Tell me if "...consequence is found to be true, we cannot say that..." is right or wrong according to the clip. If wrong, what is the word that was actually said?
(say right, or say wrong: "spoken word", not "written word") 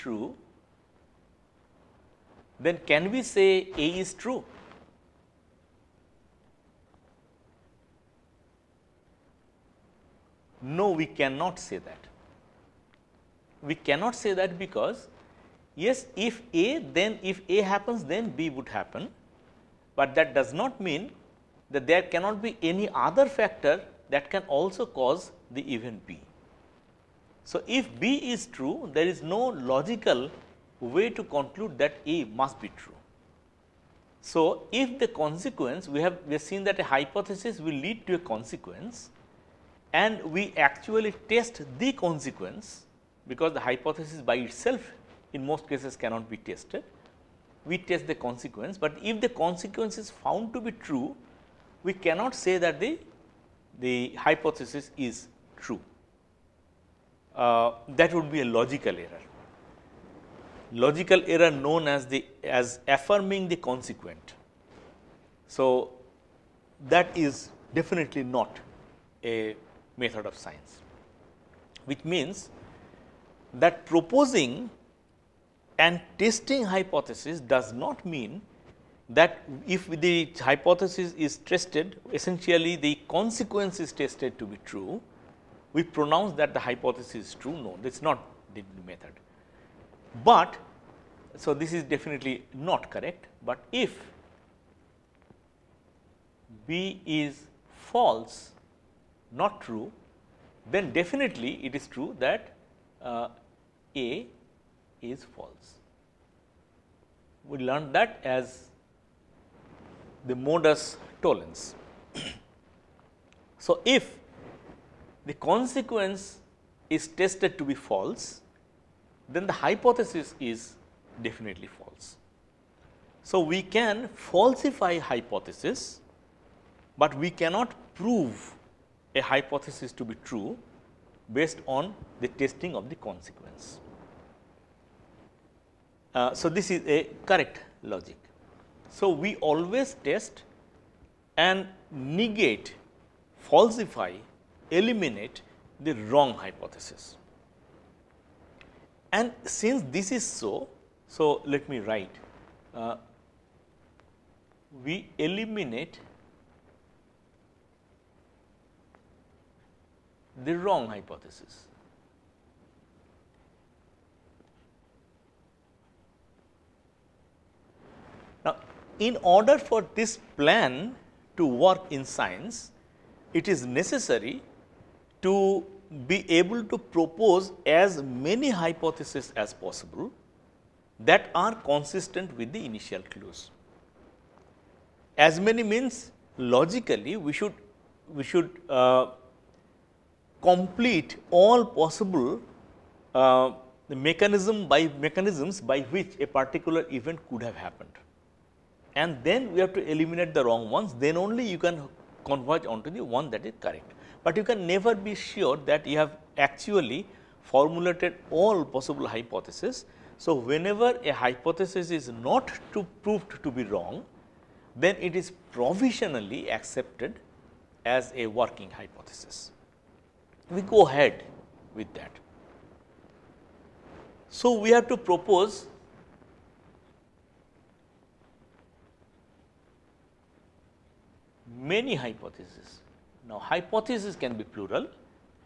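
right.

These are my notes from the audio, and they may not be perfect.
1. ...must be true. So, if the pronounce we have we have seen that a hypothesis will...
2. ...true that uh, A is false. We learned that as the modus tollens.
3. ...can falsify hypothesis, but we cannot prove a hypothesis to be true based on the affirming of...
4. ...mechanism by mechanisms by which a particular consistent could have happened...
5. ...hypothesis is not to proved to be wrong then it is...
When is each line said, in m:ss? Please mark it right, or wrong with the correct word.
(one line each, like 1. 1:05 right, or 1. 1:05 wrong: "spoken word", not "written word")
1. 0:32 wrong: "consequence", not "pronounce"
2. 1:41 right
3. 2:03 wrong: "testing", not "affirming"
4. 3:14 wrong: "event", not "consistent"
5. 3:31 right.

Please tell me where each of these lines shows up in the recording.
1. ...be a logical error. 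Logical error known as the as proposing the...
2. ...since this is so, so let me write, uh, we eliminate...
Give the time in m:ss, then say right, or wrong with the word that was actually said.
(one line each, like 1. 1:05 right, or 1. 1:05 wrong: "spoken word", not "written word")
1. 0:58 wrong: "affirming", not "proposing"
2. 2:29 right.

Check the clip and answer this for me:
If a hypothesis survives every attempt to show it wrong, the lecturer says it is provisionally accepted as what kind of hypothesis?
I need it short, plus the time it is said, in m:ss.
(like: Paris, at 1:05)
working hypothesis, at 3:38.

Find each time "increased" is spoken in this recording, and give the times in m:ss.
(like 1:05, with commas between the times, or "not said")
not said.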